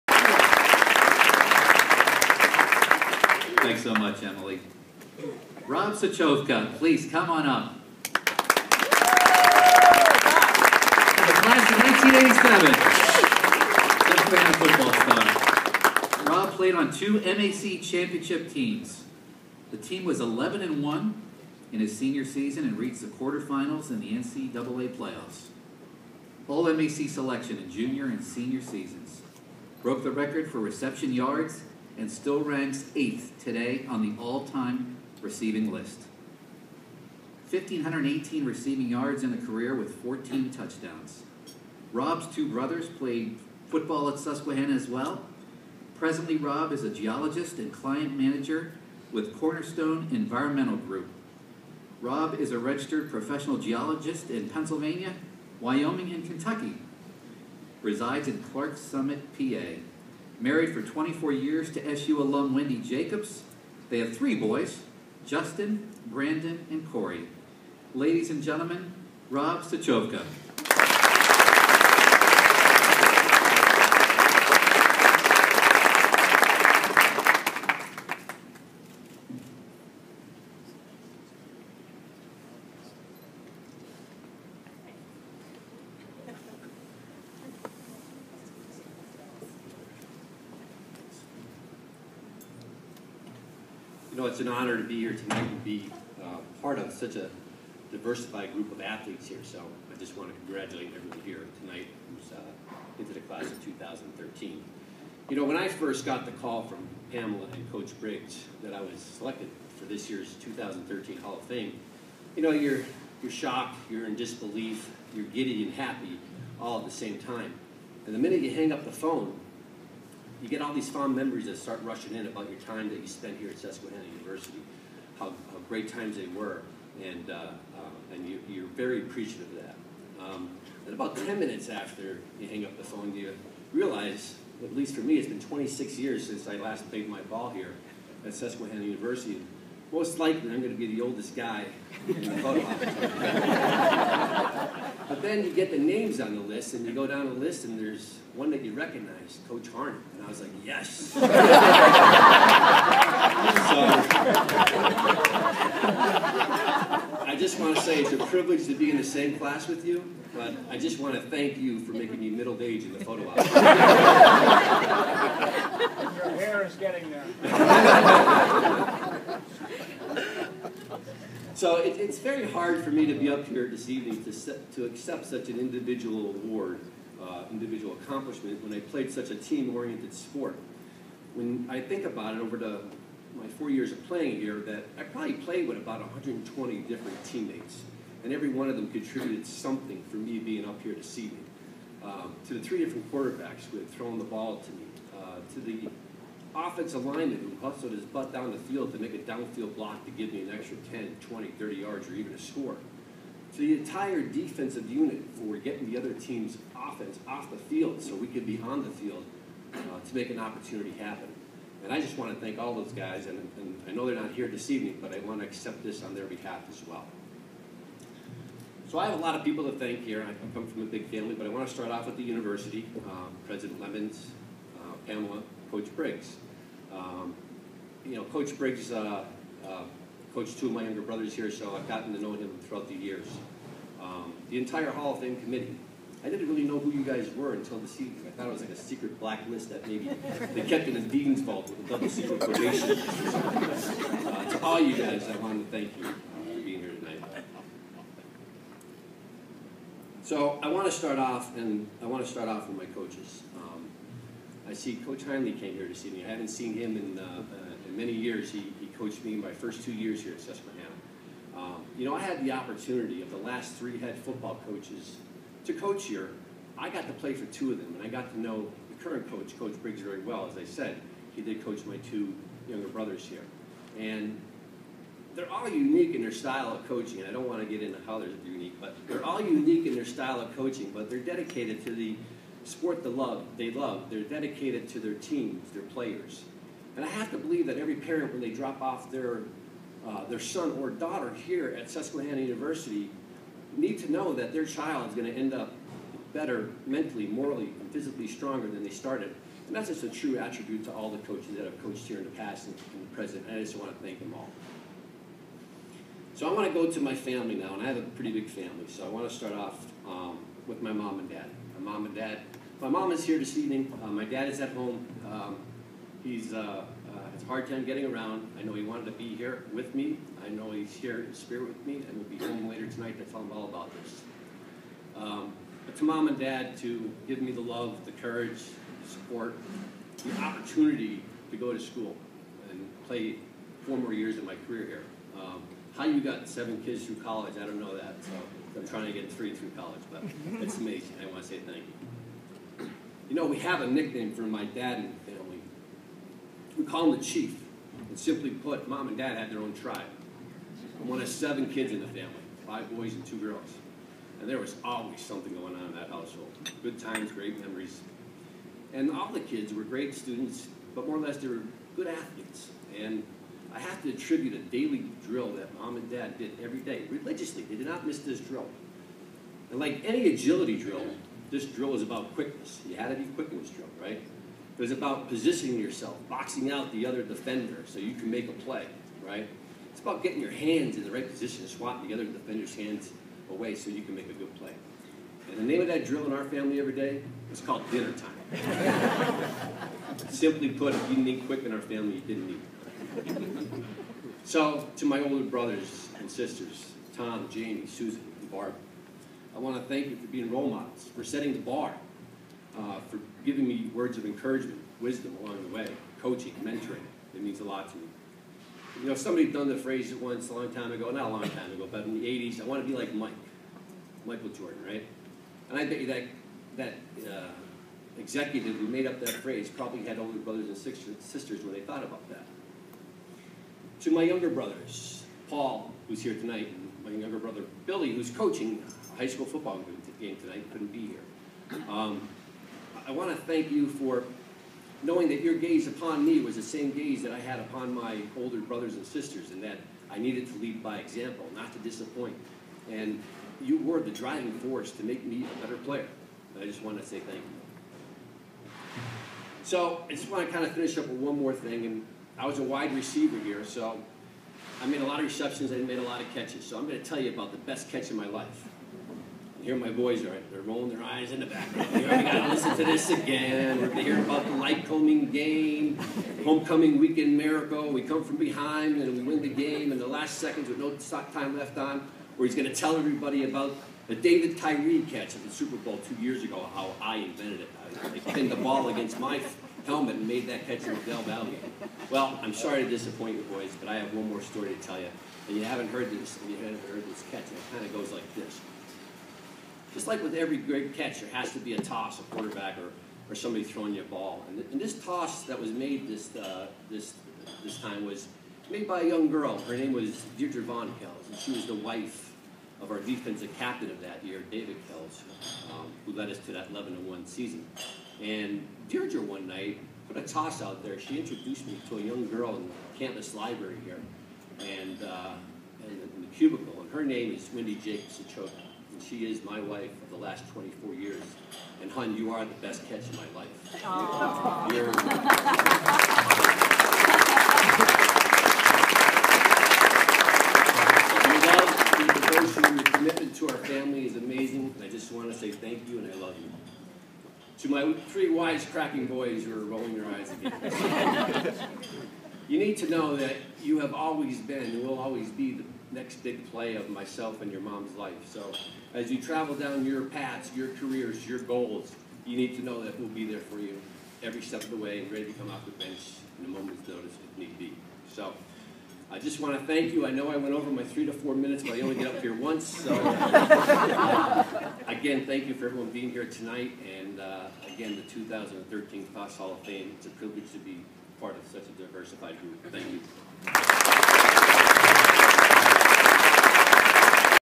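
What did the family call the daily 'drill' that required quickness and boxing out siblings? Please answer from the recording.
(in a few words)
dinner time.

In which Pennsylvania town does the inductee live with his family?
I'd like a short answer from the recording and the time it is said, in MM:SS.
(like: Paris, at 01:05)
Clarks Summit, at 00:58.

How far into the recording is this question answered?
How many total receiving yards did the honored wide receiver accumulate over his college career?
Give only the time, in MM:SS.
00:37.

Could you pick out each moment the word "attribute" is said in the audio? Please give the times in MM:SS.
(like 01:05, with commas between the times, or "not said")
05:00, 06:04.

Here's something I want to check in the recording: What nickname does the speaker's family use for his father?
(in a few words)
the Chief.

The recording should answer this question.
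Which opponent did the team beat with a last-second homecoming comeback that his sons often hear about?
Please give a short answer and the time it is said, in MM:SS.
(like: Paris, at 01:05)
Lycoming, at 07:44.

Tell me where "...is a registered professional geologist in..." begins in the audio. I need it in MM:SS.
00:52.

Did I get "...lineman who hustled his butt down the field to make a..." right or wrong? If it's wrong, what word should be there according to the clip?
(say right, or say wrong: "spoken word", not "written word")
right.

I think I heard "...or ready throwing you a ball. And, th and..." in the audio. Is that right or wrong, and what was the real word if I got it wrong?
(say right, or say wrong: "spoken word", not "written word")
wrong: "somebody", not "ready".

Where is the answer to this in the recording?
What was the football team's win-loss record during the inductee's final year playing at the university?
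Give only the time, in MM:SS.
00:20.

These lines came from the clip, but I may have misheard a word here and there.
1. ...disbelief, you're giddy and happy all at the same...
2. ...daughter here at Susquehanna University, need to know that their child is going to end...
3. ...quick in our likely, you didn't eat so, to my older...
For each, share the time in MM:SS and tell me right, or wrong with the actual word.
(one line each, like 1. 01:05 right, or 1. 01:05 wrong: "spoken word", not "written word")
1. 01:54 right
2. 04:50 right
3. 06:31 wrong: "family", not "likely".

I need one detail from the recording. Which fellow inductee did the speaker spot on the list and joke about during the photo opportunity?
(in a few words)
Coach Harney.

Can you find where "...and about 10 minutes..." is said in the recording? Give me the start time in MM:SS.
02:10.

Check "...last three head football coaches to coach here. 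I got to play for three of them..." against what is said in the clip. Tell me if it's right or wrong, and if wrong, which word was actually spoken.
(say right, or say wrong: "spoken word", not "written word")
wrong: "two", not "three".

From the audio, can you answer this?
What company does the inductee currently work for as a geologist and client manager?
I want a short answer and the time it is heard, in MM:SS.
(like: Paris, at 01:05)
Cornerstone Environmental Group, at 00:49.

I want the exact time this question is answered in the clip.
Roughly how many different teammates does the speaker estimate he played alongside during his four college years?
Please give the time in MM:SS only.
03:05.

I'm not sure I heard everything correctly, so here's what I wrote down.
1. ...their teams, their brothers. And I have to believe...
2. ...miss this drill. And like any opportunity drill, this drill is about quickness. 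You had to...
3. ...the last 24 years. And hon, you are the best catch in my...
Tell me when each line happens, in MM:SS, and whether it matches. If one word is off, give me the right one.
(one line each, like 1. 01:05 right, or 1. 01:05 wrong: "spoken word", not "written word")
1. 04:44 wrong: "players", not "brothers"
2. 06:08 wrong: "agility", not "opportunity"
3. 08:40 right.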